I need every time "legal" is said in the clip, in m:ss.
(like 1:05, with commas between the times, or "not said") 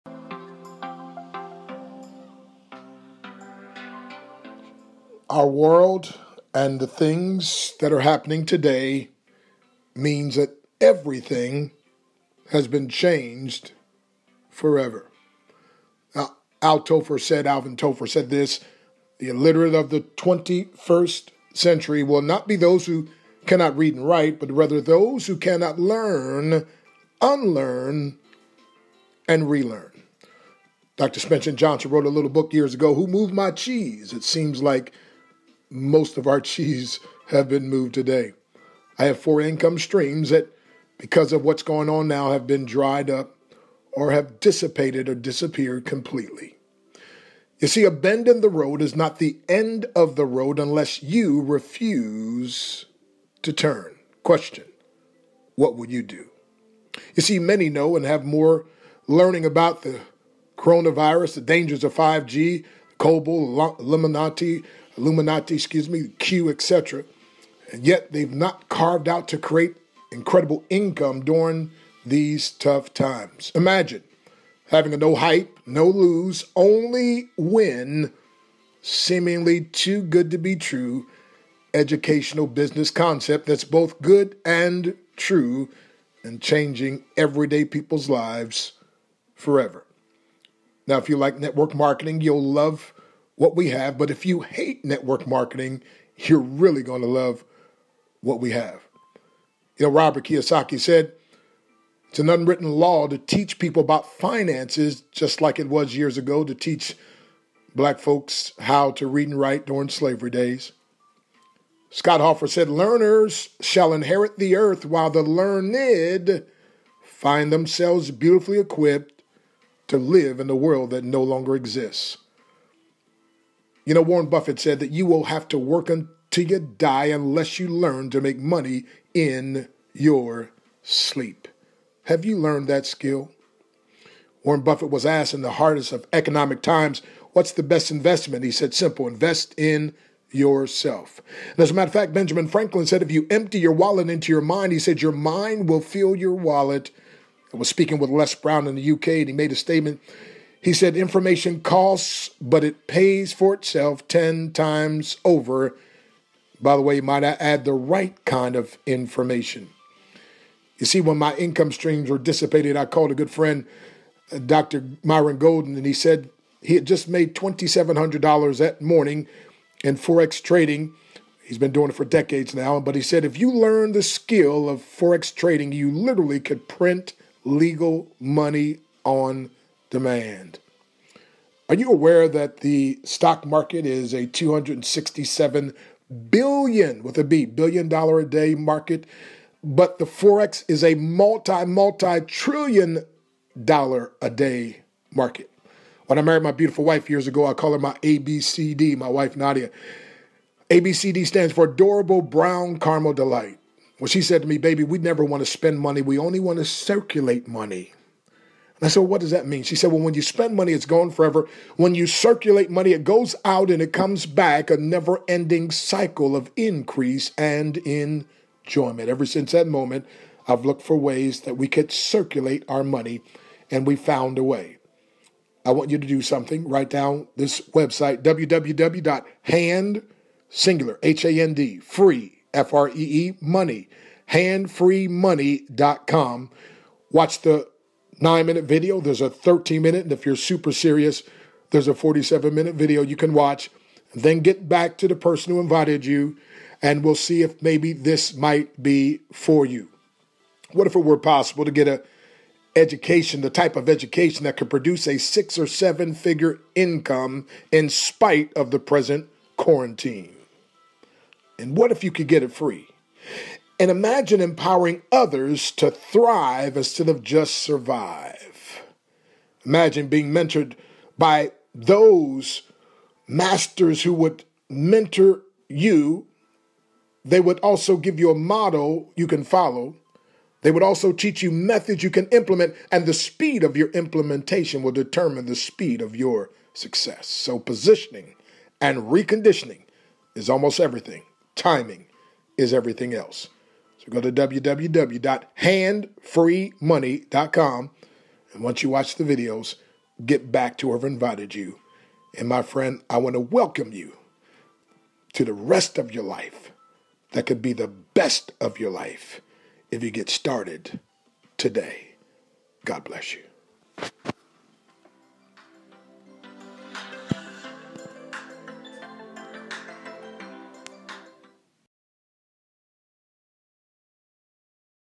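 2:57.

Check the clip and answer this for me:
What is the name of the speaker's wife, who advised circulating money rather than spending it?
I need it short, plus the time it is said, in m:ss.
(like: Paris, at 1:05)
Nadia, at 3:19.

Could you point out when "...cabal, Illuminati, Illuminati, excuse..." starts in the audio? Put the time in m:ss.
1:03.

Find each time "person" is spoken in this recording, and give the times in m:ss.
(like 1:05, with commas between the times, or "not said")
4:05.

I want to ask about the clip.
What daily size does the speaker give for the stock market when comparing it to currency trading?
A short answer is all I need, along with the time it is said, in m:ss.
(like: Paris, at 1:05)
267 billion dollars, at 3:04.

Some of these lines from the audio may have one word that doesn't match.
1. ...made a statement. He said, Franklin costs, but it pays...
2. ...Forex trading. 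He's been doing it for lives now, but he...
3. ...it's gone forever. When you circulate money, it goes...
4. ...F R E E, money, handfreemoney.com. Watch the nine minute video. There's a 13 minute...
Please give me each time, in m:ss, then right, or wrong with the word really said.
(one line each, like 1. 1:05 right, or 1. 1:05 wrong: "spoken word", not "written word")
1. 2:29 wrong: "Information", not "Franklin"
2. 2:49 wrong: "decades", not "lives"
3. 3:30 right
4. 3:52 right.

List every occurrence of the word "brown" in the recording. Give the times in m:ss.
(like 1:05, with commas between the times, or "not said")
2:28, 3:22.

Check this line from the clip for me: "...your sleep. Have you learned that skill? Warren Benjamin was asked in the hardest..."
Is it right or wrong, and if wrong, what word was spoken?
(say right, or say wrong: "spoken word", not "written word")
wrong: "Buffett", not "Benjamin".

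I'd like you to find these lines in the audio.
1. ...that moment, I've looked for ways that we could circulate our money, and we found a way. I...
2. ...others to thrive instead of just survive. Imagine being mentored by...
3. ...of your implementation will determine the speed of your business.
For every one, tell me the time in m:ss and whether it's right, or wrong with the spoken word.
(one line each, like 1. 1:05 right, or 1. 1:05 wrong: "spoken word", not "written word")
1. 3:39 right
2. 4:25 right
3. 4:43 wrong: "success", not "business".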